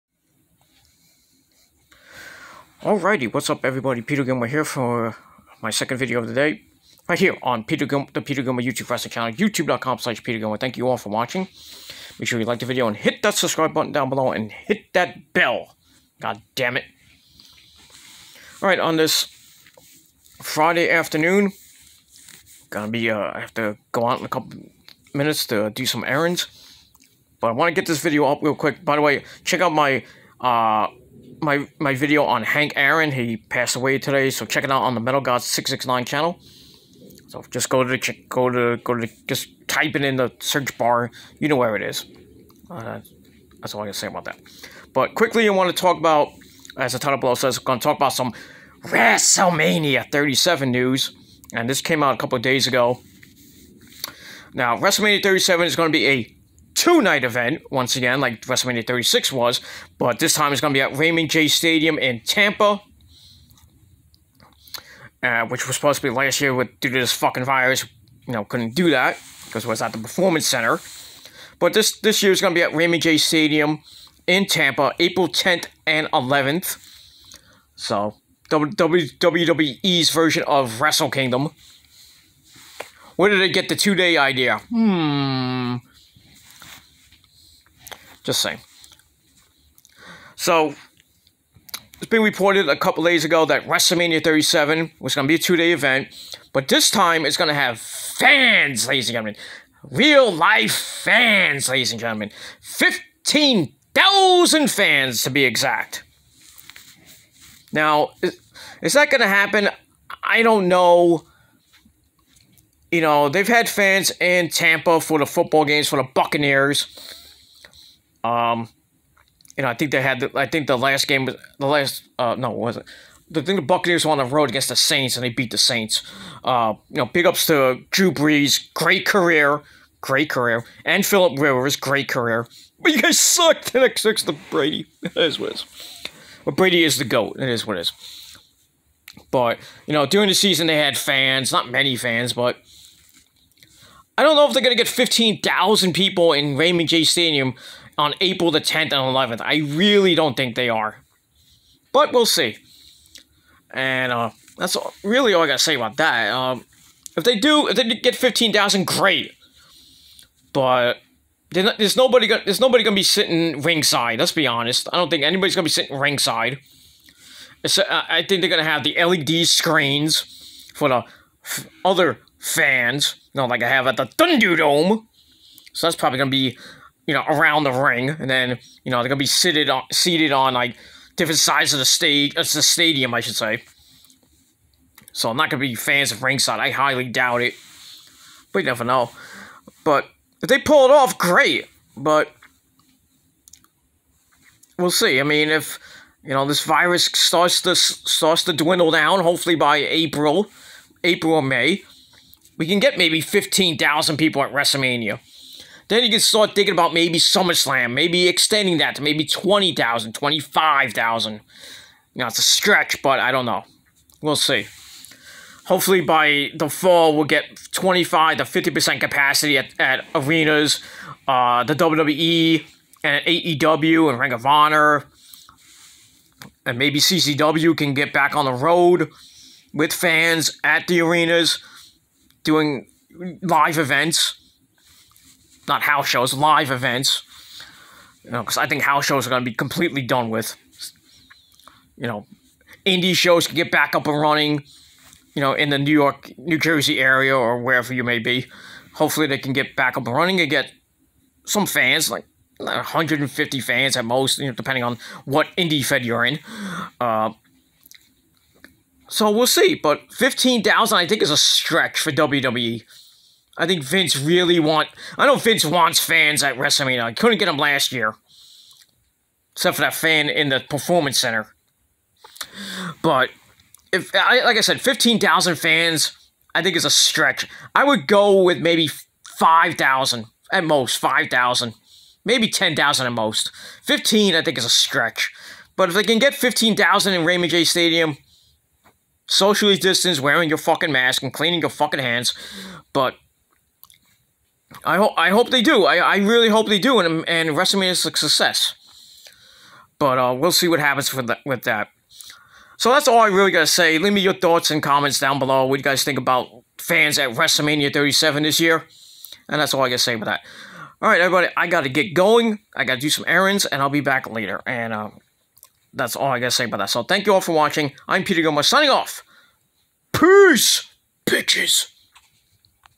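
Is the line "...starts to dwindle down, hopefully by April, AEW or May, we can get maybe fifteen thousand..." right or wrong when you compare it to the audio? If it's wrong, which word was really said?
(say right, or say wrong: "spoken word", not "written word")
wrong: "April", not "AEW".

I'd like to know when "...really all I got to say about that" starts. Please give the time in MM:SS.
02:35.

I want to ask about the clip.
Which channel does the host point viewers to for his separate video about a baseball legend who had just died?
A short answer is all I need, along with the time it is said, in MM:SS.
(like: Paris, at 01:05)
Metal Gods 669, at 00:35.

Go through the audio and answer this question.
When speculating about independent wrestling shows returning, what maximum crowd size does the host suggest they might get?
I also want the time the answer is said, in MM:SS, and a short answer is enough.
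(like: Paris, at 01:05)
150, at 04:12.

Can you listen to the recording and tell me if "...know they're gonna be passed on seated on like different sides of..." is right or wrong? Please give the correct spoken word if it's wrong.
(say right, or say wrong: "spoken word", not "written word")
wrong: "seated", not "passed".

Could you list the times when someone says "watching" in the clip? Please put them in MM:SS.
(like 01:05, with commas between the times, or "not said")
00:11, 05:17.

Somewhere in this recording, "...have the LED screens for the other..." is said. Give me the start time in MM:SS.
02:48.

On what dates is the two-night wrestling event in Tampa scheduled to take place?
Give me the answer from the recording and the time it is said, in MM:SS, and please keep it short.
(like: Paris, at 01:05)
April 10th and 11th, at 01:14.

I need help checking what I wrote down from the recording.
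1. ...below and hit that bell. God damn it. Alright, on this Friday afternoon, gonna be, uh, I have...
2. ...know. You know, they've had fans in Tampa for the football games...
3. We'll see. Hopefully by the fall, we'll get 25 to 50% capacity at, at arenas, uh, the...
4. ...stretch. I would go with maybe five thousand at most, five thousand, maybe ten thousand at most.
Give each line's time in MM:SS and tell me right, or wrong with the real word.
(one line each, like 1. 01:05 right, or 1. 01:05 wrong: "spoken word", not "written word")
1. 00:14 right
2. 01:50 right
3. 03:34 right
4. 04:36 right.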